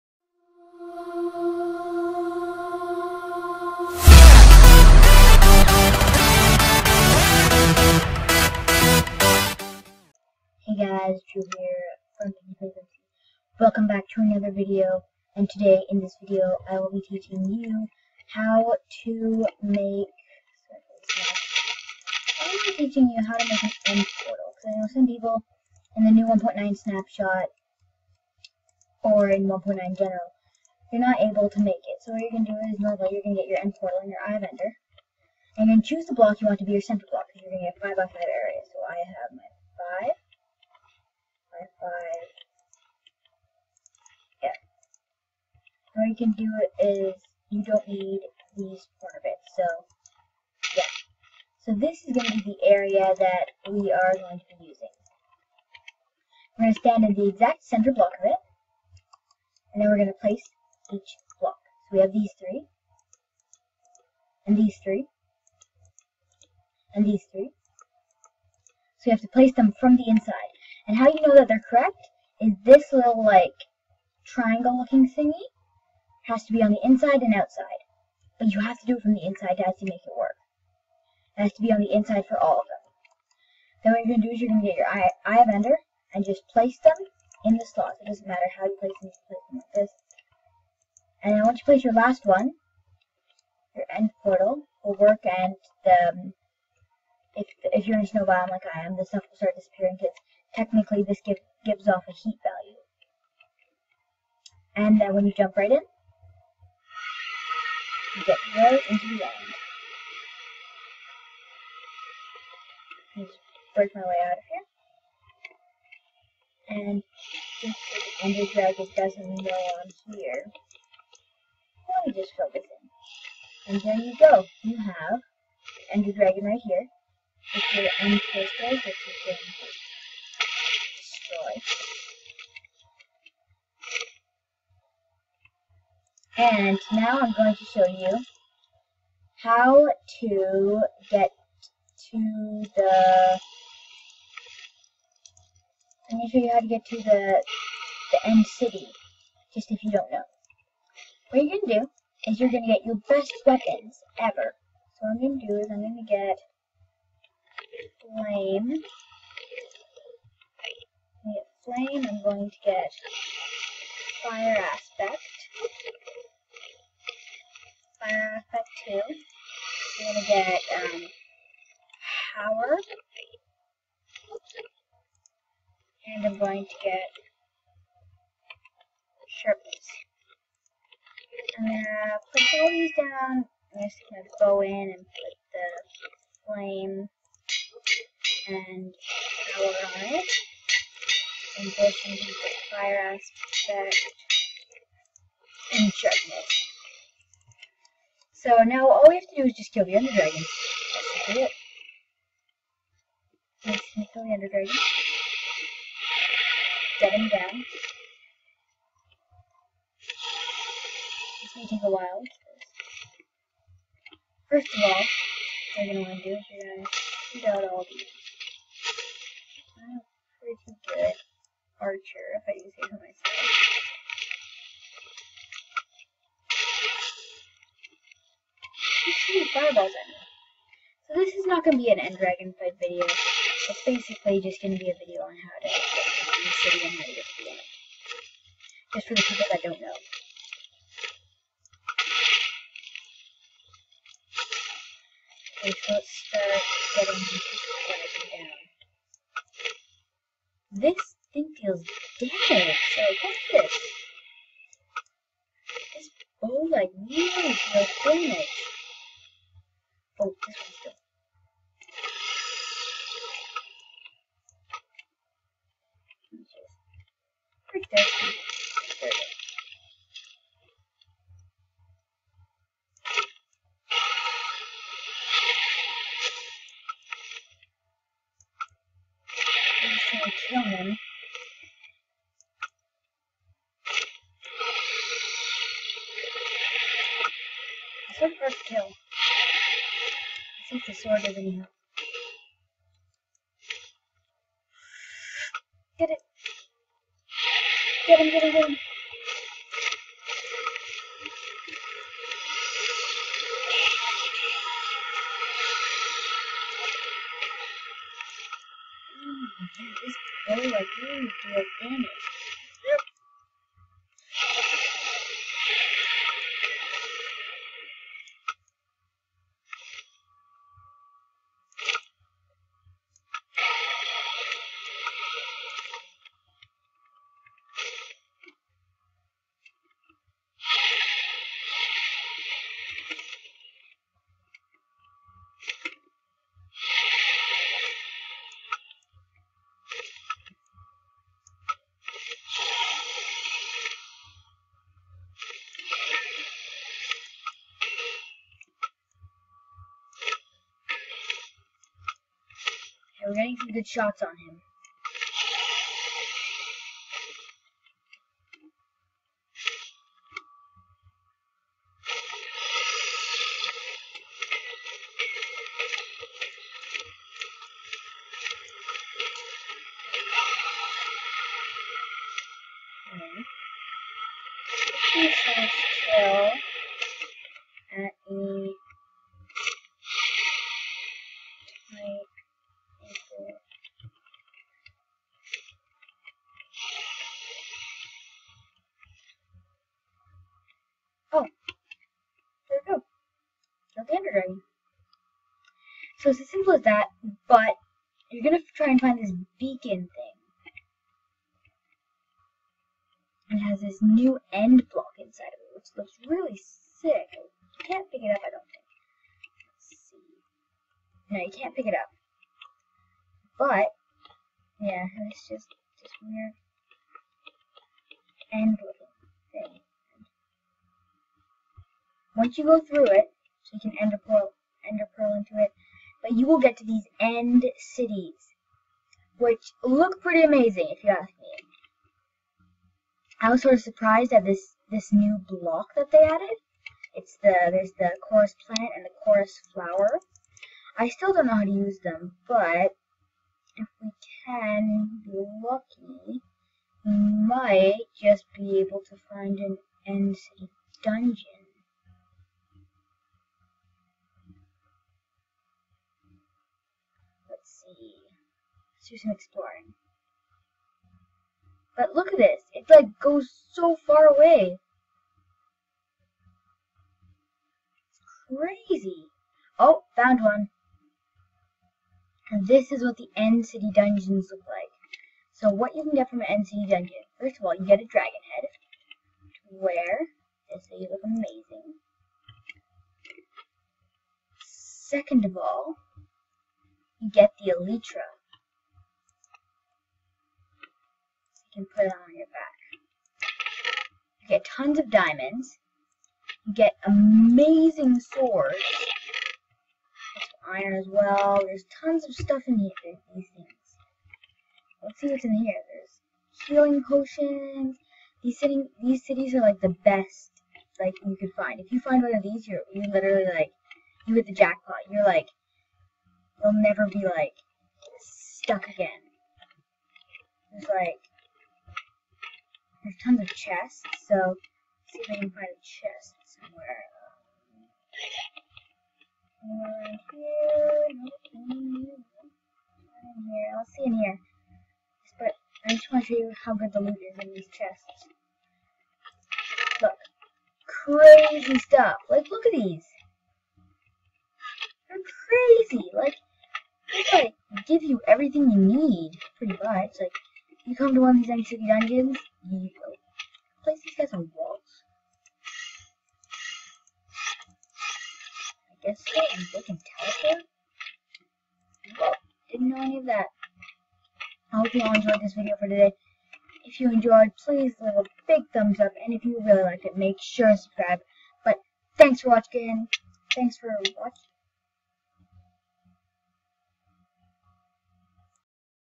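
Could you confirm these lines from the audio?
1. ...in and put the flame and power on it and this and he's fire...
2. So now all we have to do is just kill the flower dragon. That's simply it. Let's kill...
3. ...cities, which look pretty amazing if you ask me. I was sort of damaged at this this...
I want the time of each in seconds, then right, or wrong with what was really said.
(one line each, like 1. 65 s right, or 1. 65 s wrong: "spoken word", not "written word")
1. 184 s right
2. 198 s wrong: "ender", not "flower"
3. 427 s wrong: "surprised", not "damaged".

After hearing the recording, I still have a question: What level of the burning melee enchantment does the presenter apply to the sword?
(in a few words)
2.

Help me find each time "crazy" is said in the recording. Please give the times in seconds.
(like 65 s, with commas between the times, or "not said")
468 s, 540 s, 545 s.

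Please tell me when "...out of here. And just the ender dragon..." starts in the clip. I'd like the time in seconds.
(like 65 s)
114 s.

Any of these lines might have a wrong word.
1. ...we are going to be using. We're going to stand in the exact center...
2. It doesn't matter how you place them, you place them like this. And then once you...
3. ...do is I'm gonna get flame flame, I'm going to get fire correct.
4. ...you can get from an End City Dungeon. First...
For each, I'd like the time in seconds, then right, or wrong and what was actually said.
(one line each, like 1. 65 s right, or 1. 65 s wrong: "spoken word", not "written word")
1. 53 s right
2. 88 s right
3. 155 s wrong: "aspect", not "correct"
4. 475 s right.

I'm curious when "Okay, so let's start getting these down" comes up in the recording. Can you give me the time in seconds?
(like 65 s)
245 s.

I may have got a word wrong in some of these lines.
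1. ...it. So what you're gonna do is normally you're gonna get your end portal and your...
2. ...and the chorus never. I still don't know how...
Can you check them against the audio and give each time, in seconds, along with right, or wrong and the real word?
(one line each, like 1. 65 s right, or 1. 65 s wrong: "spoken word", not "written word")
1. 31 s right
2. 438 s wrong: "flower", not "never".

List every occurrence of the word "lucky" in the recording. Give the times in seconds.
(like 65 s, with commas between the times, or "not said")
445 s.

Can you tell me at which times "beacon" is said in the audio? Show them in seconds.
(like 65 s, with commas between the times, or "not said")
399 s.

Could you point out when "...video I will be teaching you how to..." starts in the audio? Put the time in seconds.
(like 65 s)
16 s.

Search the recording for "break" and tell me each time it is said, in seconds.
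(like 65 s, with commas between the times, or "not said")
113 s, 267 s.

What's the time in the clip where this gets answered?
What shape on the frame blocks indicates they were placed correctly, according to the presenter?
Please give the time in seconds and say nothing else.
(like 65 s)
74 s.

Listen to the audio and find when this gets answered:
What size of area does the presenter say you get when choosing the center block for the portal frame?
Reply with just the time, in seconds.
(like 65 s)
37 s.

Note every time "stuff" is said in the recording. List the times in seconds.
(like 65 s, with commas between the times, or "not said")
99 s, 502 s, 541 s.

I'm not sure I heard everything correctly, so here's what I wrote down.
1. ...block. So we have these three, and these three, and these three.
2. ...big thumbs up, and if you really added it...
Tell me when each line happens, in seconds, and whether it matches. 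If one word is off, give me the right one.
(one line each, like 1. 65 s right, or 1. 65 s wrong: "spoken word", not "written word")
1. 61 s right
2. 568 s wrong: "liked", not "added".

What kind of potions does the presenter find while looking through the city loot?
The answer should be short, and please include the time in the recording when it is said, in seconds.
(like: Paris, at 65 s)
healing potions, at 506 s.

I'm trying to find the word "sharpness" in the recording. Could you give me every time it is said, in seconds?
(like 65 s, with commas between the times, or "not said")
179 s, 195 s.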